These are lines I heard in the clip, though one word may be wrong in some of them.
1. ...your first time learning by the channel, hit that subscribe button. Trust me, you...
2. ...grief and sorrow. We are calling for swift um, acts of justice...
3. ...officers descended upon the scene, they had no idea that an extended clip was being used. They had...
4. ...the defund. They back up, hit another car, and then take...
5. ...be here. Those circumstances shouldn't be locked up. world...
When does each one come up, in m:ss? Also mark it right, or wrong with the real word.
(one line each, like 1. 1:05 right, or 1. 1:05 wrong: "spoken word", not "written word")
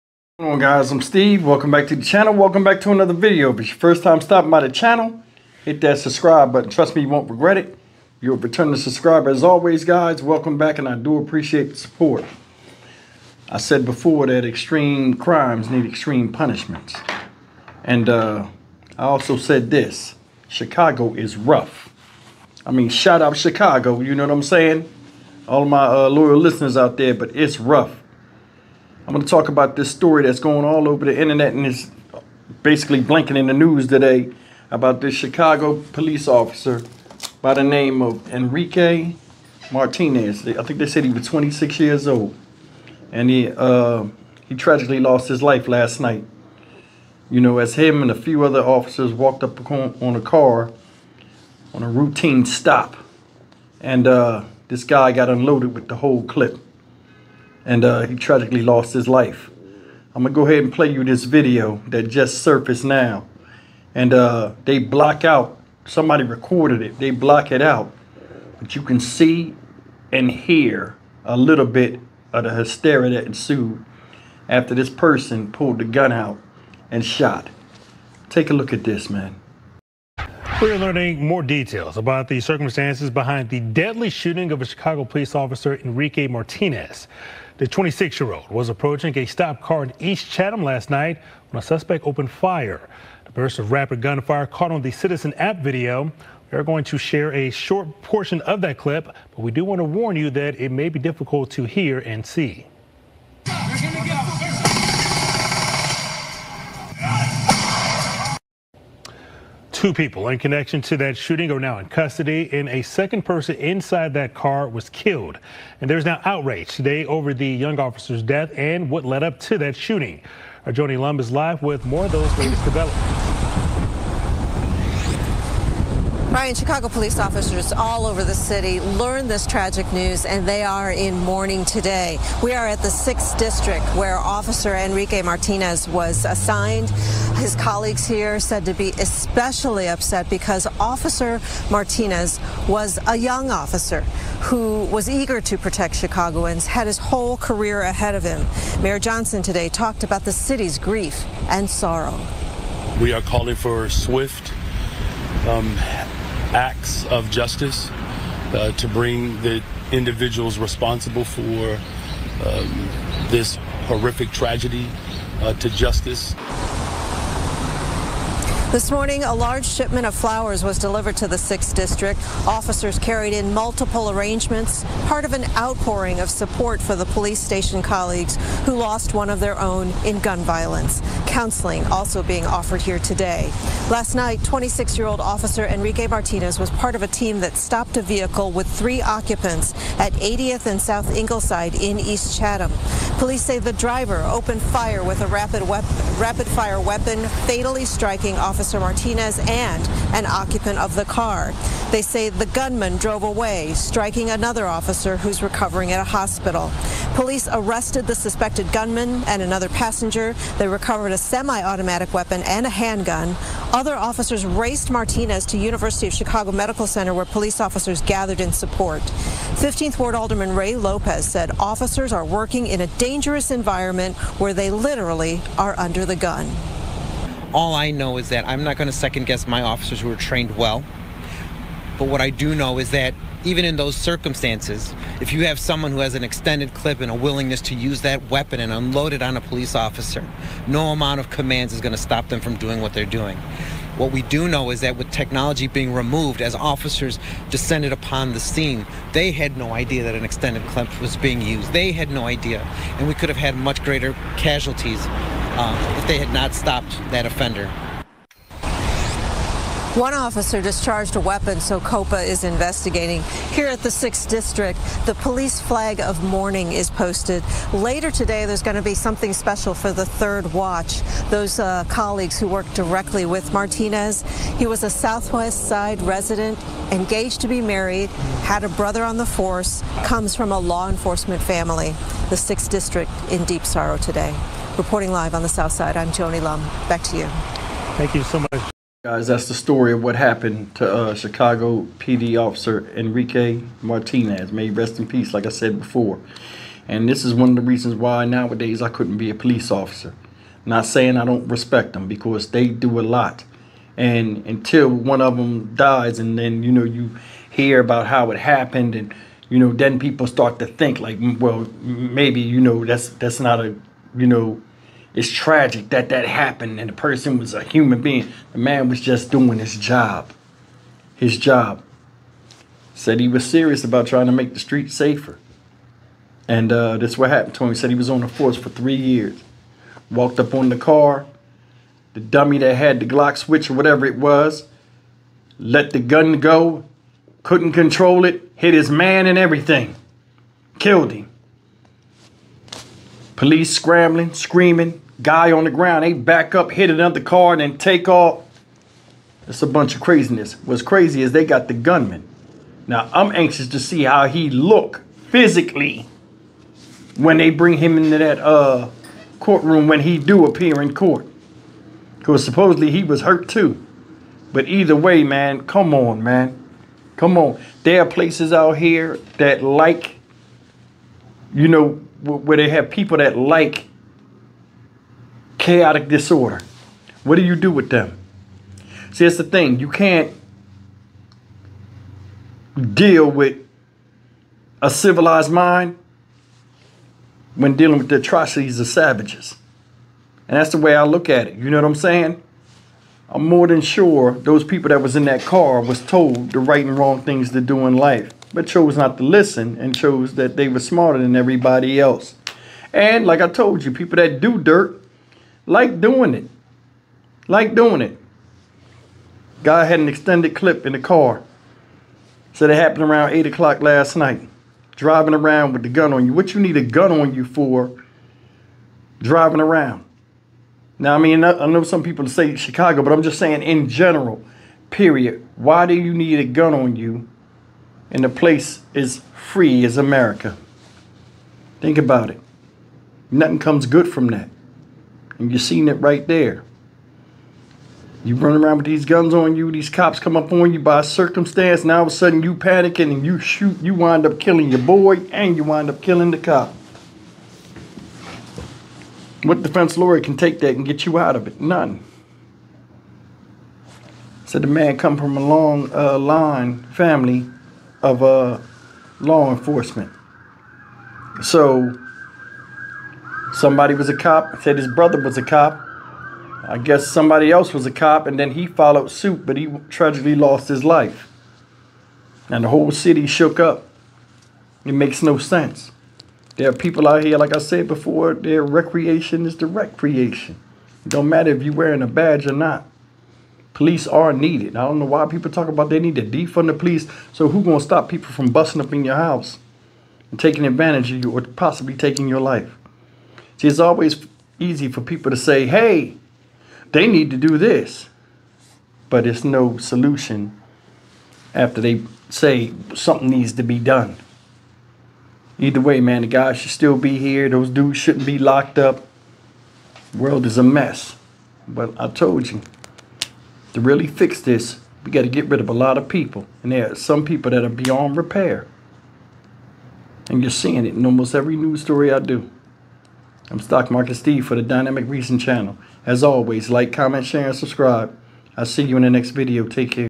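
1. 0:03 wrong: "stopping", not "learning"
2. 2:30 right
3. 4:06 right
4. 5:45 wrong: "ground", not "defund"
5. 8:26 wrong: "dudes", not "circumstances".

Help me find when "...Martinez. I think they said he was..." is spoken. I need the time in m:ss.
0:39.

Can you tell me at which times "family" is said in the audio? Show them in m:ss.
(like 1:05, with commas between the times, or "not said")
4:41, 7:36.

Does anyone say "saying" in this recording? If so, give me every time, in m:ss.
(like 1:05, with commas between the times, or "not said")
0:24, 5:00, 6:31, 7:03.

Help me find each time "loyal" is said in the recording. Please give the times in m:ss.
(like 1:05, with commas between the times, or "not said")
0:26.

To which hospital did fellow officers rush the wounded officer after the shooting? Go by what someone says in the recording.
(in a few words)
University of Chicago Medical Center.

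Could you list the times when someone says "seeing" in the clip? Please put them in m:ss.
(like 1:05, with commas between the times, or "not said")
7:15, 8:40.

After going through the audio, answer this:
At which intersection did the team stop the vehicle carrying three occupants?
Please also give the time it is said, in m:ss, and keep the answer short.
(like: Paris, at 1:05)
80th and South Ingleside, at 3:10.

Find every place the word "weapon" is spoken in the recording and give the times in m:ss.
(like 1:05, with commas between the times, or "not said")
3:16, 3:32, 3:58, 4:21.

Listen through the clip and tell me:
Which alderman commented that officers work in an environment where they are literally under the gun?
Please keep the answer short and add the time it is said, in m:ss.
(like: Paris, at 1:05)
Ray Lopez, at 3:40.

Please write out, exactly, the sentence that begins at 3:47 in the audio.
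All I know is that I'm not going to second guess my officers who are trained well.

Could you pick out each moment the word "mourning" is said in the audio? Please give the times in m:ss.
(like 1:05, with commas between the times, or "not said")
2:11, 4:26.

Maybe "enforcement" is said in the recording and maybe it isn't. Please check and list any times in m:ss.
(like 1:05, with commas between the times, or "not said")
4:40, 7:39.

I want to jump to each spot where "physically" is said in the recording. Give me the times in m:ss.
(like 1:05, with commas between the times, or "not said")
5:55.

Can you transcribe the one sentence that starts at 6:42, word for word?
And like I told you, people that do dirt like doing it.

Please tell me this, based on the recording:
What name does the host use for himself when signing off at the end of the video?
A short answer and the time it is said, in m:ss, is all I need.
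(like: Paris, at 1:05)
Stock Market Steve, at 8:43.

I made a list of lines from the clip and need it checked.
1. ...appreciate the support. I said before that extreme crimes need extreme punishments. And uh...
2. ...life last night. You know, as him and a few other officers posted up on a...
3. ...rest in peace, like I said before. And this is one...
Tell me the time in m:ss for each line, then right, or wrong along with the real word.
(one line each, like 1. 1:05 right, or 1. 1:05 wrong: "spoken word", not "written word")
1. 0:11 right
2. 0:45 wrong: "walked", not "posted"
3. 4:54 right.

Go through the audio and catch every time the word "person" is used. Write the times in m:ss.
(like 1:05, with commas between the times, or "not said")
1:14, 1:53, 5:16.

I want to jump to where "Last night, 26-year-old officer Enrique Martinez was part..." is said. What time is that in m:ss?
3:03.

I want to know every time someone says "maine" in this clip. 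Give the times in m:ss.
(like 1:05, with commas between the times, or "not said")
not said.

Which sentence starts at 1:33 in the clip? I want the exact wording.
The burst of rapid gunfire caught on the Citizen app video.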